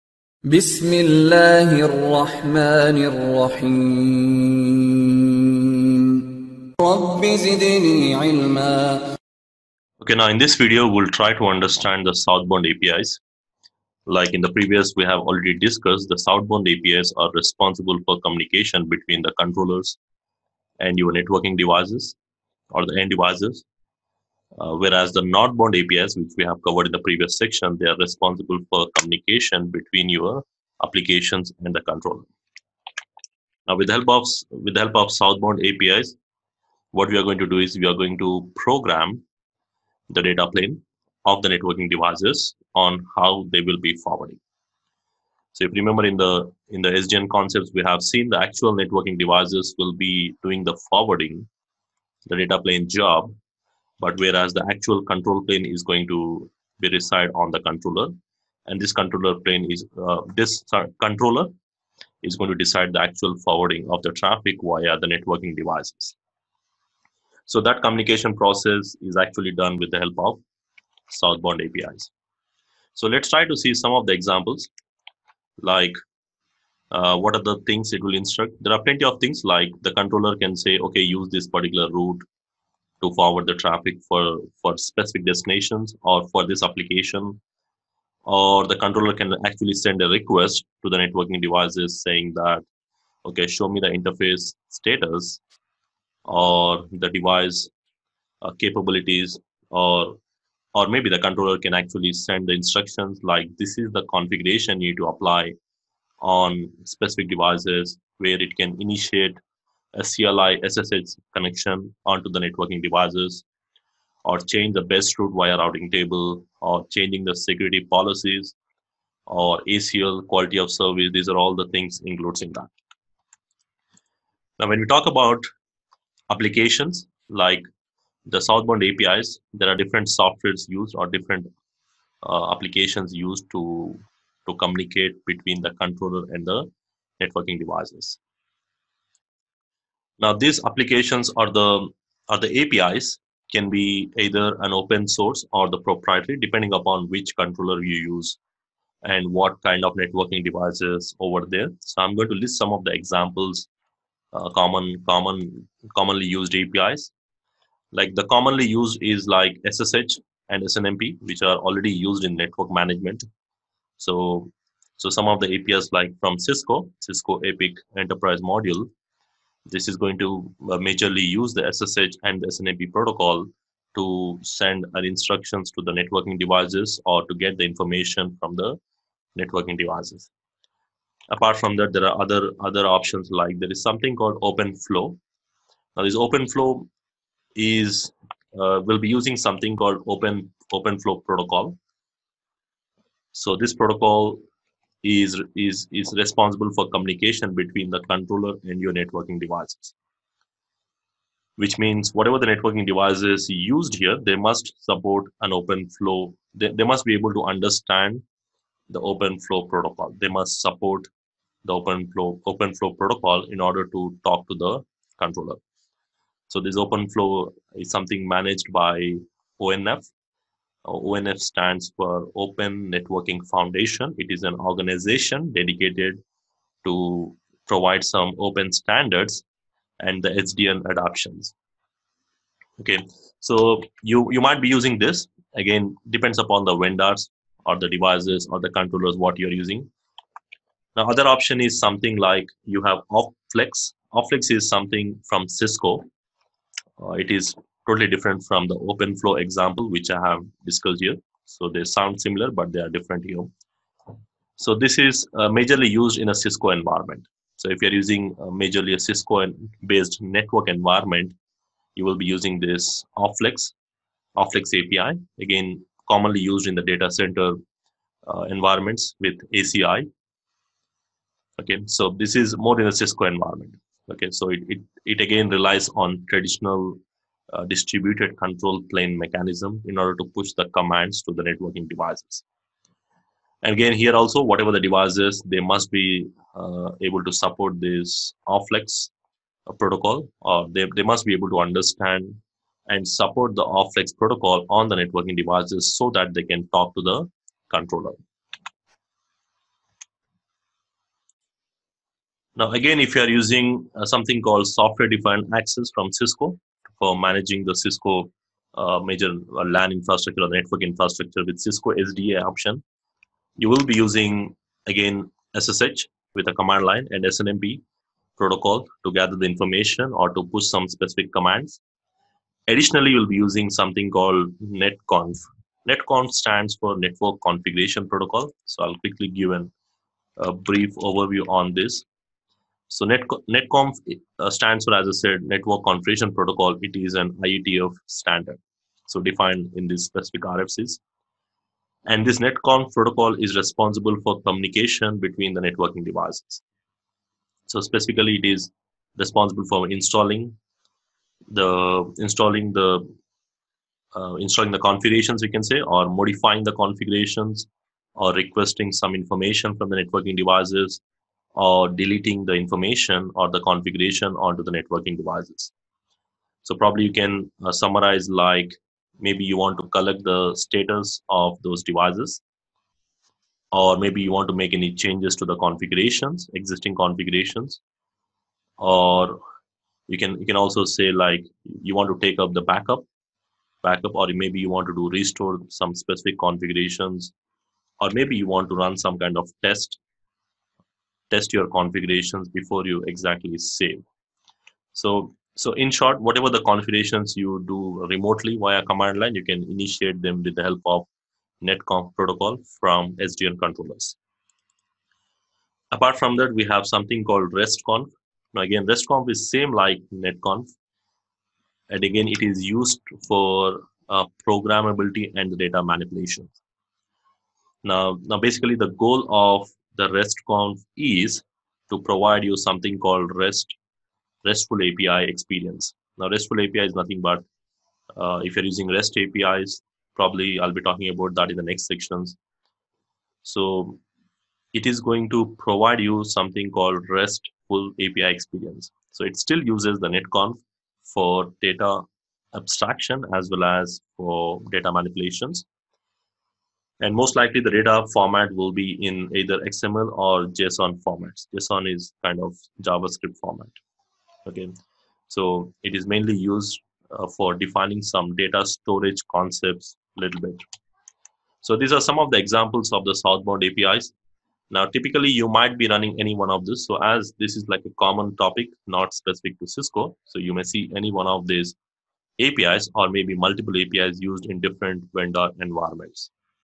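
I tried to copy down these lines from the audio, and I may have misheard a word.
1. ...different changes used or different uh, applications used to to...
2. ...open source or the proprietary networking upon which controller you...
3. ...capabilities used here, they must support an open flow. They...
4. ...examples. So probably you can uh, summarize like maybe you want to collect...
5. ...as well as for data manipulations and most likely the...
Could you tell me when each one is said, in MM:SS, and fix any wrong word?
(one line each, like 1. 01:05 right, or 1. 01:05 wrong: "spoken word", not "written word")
1. 02:09 wrong: "softwares", not "changes"
2. 02:24 wrong: "depending", not "networking"
3. 03:22 wrong: "devices", not "capabilities"
4. 06:05 wrong: "devices", not "examples"
5. 07:23 right.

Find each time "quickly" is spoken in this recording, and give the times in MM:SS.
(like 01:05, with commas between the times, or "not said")
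05:28.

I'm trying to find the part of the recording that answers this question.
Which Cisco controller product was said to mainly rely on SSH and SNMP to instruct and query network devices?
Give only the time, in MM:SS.
02:46.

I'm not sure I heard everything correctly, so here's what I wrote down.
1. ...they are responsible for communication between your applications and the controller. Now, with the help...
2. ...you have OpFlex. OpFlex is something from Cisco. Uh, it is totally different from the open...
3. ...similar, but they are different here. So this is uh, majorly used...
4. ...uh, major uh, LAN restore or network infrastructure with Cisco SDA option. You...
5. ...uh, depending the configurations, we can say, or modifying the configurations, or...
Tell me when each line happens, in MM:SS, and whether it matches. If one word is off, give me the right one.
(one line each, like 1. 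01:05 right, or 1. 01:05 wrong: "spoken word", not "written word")
1. 00:27 right
2. 04:02 right
3. 04:12 right
4. 05:08 wrong: "infrastructure", not "restore"
5. 05:54 wrong: "installing", not "depending".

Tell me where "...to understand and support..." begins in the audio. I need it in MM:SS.
04:51.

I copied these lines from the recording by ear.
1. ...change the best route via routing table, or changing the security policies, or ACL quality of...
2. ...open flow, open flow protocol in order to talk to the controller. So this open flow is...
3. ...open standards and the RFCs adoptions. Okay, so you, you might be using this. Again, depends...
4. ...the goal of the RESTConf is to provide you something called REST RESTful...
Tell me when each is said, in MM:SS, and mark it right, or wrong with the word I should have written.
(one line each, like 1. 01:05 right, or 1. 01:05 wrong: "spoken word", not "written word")
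1. 01:54 right
2. 03:31 right
3. 03:48 wrong: "SDN", not "RFCs"
4. 06:58 right.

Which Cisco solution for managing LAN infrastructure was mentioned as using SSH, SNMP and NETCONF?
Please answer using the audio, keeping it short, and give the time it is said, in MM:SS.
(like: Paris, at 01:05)
Software defined access, at 05:04.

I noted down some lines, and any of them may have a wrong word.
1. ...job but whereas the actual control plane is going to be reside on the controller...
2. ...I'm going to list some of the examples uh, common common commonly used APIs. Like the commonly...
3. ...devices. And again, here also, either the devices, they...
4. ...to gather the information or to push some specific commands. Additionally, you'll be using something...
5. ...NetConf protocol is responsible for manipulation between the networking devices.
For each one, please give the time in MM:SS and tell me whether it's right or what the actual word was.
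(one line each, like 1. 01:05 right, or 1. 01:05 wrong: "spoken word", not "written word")
1. 00:52 right
2. 02:32 right
3. 04:41 wrong: "whatever", not "either"
4. 05:19 right
5. 05:42 wrong: "communication", not "manipulation".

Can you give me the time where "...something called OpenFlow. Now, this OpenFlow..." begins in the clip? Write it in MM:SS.
03:03.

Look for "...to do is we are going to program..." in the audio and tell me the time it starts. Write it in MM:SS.
00:37.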